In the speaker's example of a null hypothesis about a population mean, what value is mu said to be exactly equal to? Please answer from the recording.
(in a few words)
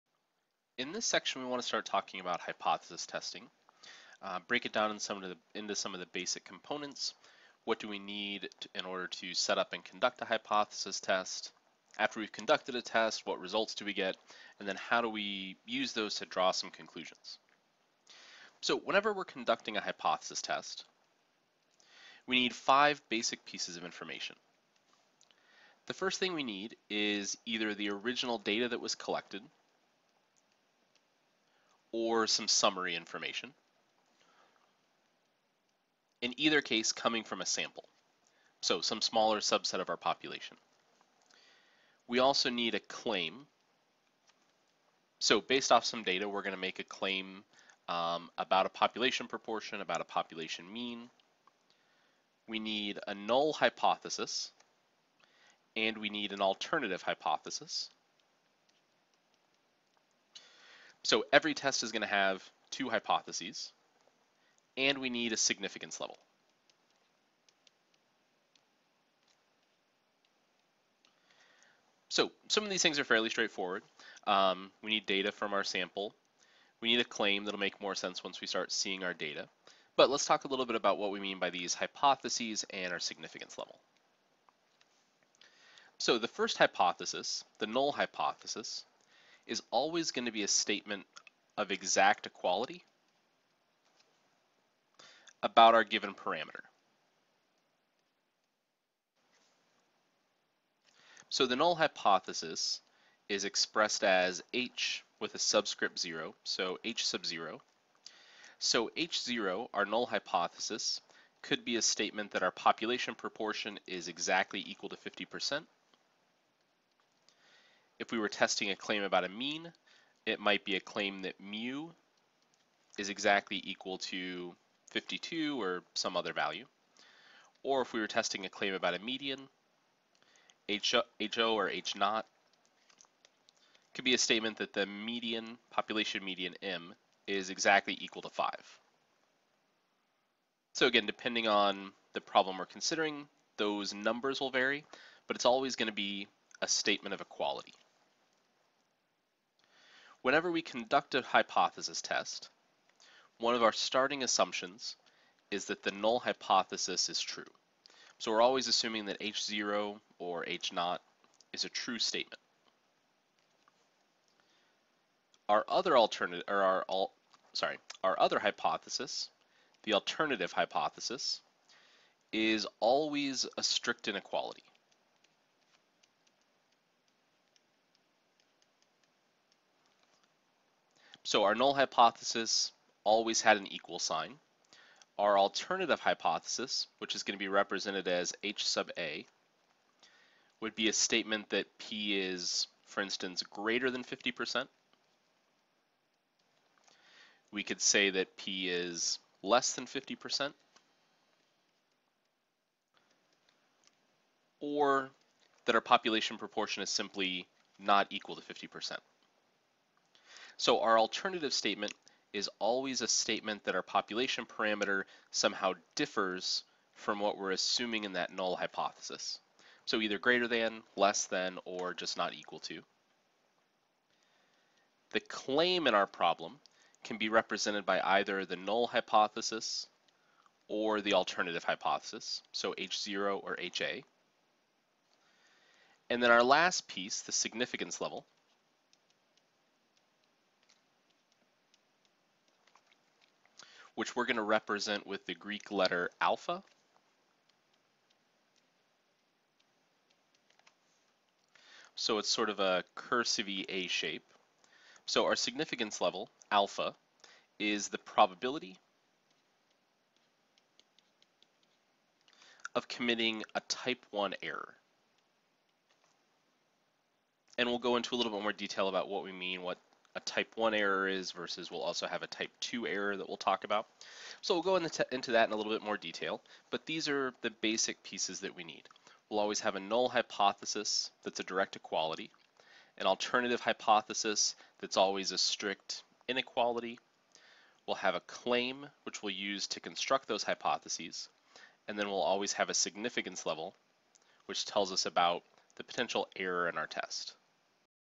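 52.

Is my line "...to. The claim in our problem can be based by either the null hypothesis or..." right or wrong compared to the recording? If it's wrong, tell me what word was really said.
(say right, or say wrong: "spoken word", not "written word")
wrong: "represented", not "based".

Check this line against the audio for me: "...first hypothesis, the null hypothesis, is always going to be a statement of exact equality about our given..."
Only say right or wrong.
right.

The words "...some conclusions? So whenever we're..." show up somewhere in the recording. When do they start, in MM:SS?
00:16.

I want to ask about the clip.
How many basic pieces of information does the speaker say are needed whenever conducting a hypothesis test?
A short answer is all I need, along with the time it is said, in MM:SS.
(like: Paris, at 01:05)
5, at 00:22.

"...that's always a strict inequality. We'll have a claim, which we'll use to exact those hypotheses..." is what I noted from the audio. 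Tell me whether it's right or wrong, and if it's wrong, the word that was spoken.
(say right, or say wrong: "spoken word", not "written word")
wrong: "construct", not "exact".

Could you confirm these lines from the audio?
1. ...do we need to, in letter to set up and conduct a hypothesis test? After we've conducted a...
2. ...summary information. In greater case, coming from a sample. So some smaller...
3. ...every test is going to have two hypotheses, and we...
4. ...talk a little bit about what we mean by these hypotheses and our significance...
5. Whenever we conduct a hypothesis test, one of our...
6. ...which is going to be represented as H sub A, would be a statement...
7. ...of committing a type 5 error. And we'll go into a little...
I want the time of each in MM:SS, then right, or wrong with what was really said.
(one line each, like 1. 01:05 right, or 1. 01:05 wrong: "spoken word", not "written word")
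1. 00:07 wrong: "order", not "letter"
2. 00:32 wrong: "either", not "greater"
3. 01:01 right
4. 01:20 right
5. 02:30 right
6. 03:06 right
7. 04:22 wrong: "1", not "5".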